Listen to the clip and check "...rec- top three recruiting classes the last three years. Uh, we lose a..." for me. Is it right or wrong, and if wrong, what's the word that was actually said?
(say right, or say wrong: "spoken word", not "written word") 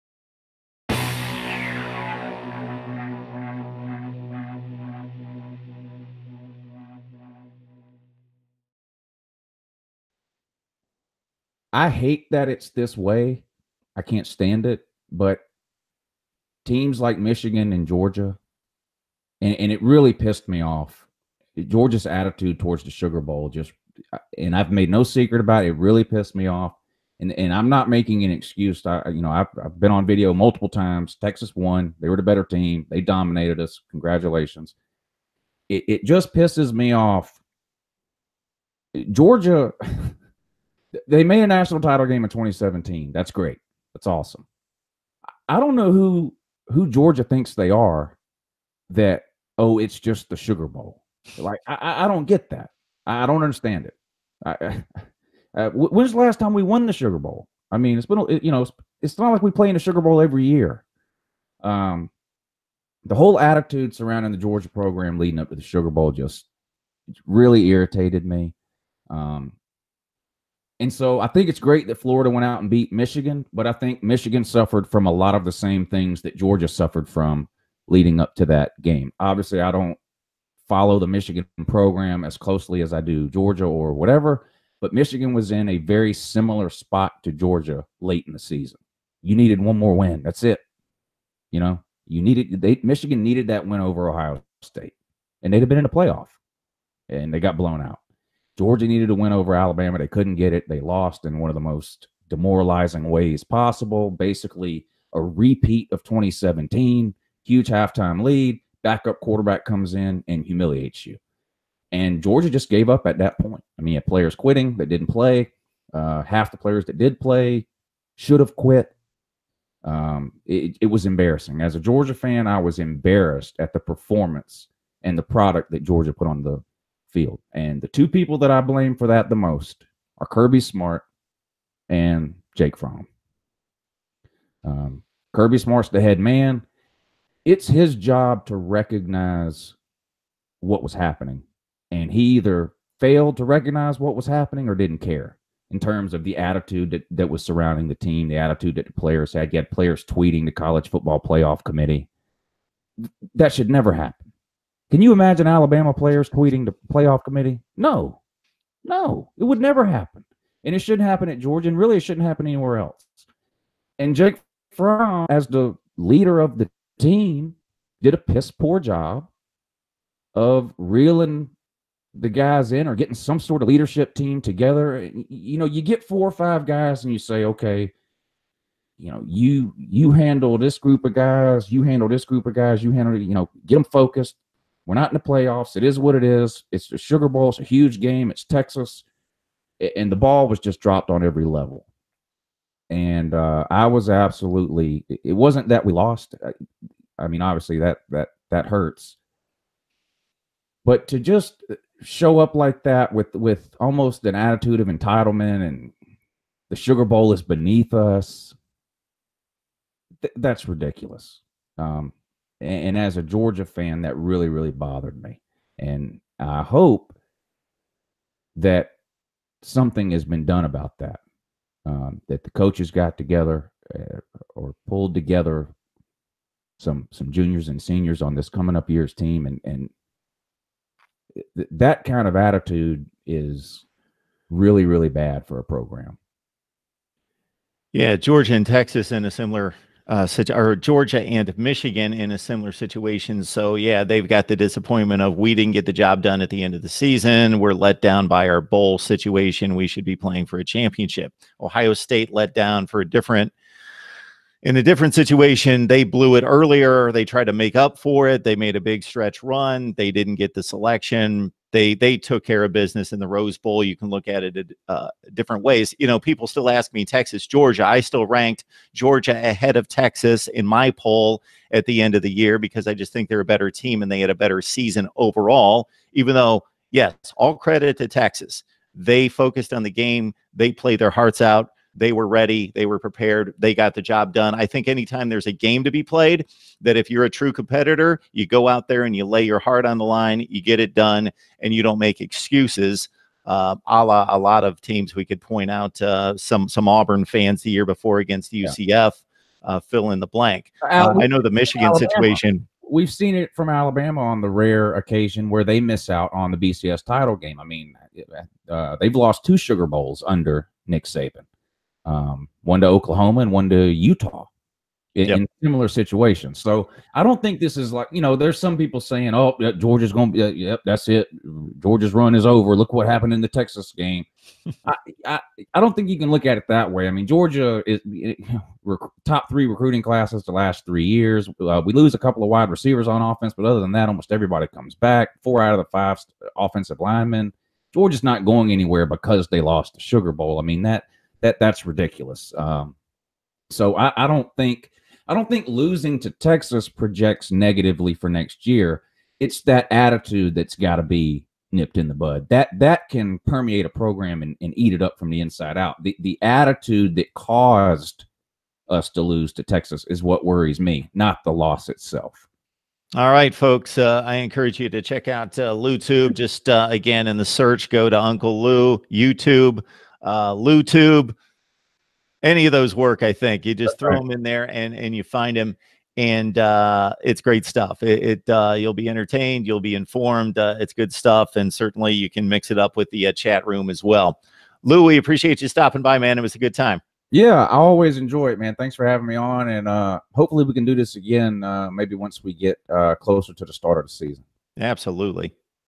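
right.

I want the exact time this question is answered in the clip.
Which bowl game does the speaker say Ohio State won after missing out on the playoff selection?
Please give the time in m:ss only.
4:23.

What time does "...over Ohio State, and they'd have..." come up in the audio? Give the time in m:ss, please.
1:33.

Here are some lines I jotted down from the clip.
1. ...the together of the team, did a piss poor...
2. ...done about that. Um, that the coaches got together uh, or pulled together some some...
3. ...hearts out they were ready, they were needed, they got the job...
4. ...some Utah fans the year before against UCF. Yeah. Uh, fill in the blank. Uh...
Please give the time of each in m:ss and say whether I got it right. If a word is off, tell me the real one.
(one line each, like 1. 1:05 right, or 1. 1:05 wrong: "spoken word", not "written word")
1. 2:45 wrong: "leader", not "together"
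2. 3:40 right
3. 4:41 wrong: "prepared", not "needed"
4. 4:56 wrong: "Auburn", not "Utah".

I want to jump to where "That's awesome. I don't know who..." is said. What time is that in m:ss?
0:43.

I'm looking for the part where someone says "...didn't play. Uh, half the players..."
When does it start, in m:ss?
1:54.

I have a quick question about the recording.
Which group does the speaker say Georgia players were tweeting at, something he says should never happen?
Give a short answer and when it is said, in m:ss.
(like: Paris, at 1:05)
the college football playoff committee, at 2:30.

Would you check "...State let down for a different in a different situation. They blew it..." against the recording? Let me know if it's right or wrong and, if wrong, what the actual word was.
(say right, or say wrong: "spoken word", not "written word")
right.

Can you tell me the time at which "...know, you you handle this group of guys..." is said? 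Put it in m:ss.
2:59.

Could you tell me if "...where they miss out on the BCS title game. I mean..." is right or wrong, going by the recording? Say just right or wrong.
right.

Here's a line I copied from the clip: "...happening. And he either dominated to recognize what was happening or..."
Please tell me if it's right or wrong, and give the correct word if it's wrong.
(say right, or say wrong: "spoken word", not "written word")
wrong: "failed", not "dominated".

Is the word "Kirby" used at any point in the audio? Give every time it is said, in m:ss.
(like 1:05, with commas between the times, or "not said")
2:10, 2:15.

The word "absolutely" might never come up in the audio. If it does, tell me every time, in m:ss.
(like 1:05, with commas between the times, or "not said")
3:14, 6:34.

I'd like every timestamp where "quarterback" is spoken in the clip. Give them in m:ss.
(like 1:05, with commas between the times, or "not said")
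1:49.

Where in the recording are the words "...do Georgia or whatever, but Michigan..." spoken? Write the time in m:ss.
1:23.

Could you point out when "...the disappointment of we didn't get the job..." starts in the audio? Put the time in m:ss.
4:04.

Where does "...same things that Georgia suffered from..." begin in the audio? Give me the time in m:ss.
1:15.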